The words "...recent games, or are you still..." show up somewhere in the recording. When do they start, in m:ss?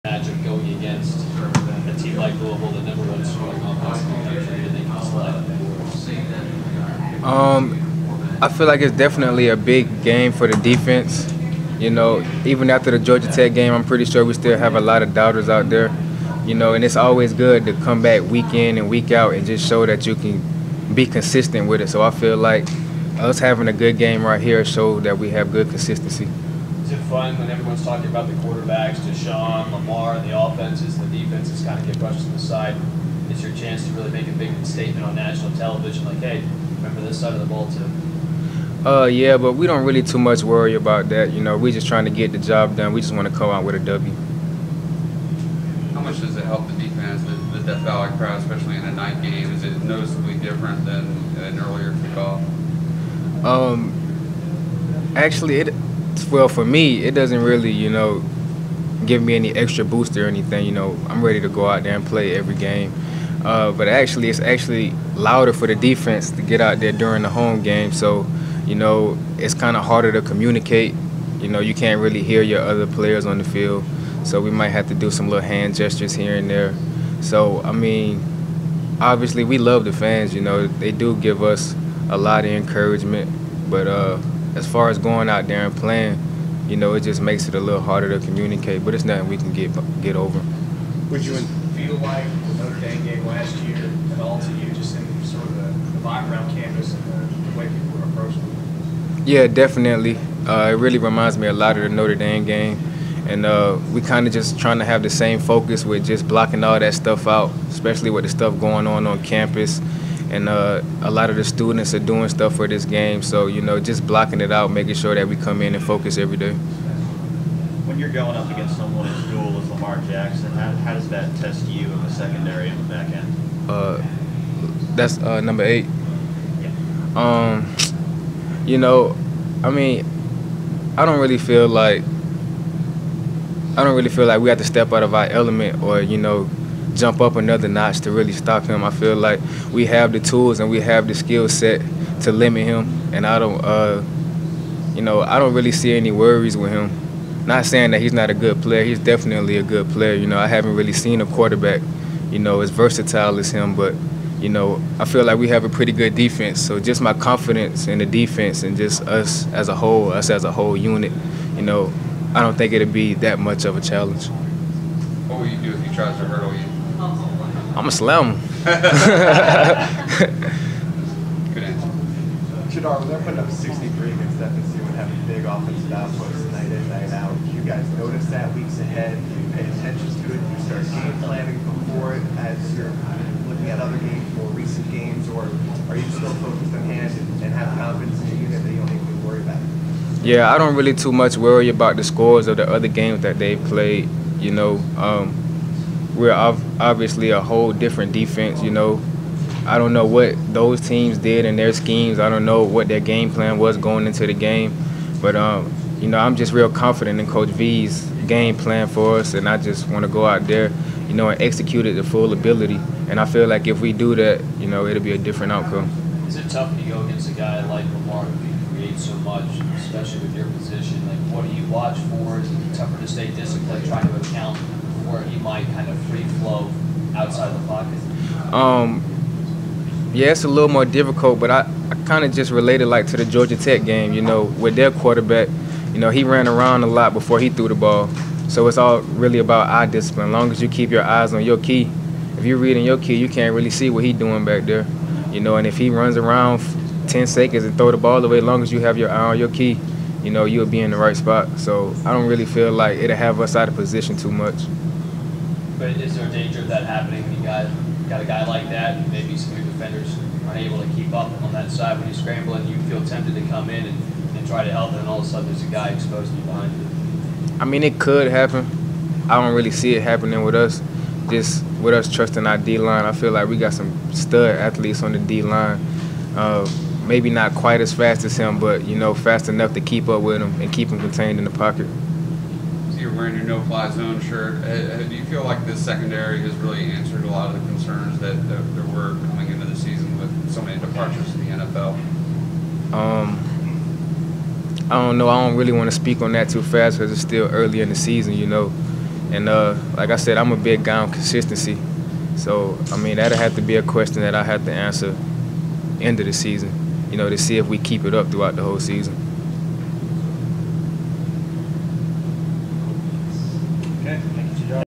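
3:04.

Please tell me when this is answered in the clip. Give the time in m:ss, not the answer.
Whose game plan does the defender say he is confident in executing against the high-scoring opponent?
3:27.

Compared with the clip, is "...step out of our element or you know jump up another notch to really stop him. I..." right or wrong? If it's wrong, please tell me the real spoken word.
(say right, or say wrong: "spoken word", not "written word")
right.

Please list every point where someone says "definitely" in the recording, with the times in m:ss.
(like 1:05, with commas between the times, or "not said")
0:08, 1:39, 2:28.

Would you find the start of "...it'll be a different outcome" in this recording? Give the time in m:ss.
3:34.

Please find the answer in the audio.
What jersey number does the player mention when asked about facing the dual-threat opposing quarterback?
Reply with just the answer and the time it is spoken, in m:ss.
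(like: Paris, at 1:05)
8, at 2:05.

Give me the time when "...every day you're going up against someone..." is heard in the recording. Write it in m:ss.
1:56.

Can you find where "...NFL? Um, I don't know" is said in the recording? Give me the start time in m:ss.
4:51.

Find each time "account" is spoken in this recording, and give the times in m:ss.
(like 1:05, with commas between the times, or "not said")
3:44.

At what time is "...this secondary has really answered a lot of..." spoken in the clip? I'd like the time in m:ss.
4:45.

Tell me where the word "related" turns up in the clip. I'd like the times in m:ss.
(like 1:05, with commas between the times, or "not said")
3:52.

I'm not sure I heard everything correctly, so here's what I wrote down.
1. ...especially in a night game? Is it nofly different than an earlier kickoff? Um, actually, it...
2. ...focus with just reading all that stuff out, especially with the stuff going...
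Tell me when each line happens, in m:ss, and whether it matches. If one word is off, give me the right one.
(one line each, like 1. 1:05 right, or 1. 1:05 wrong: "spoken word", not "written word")
1. 0:48 wrong: "noticeably", not "nofly"
2. 1:45 wrong: "blocking", not "reading".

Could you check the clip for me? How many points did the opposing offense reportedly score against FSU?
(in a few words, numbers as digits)
63.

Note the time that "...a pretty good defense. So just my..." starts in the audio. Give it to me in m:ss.
2:35.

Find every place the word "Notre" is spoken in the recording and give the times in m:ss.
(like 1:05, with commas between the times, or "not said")
1:32, 1:41.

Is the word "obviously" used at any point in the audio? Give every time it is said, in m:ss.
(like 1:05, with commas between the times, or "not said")
1:19, 3:16.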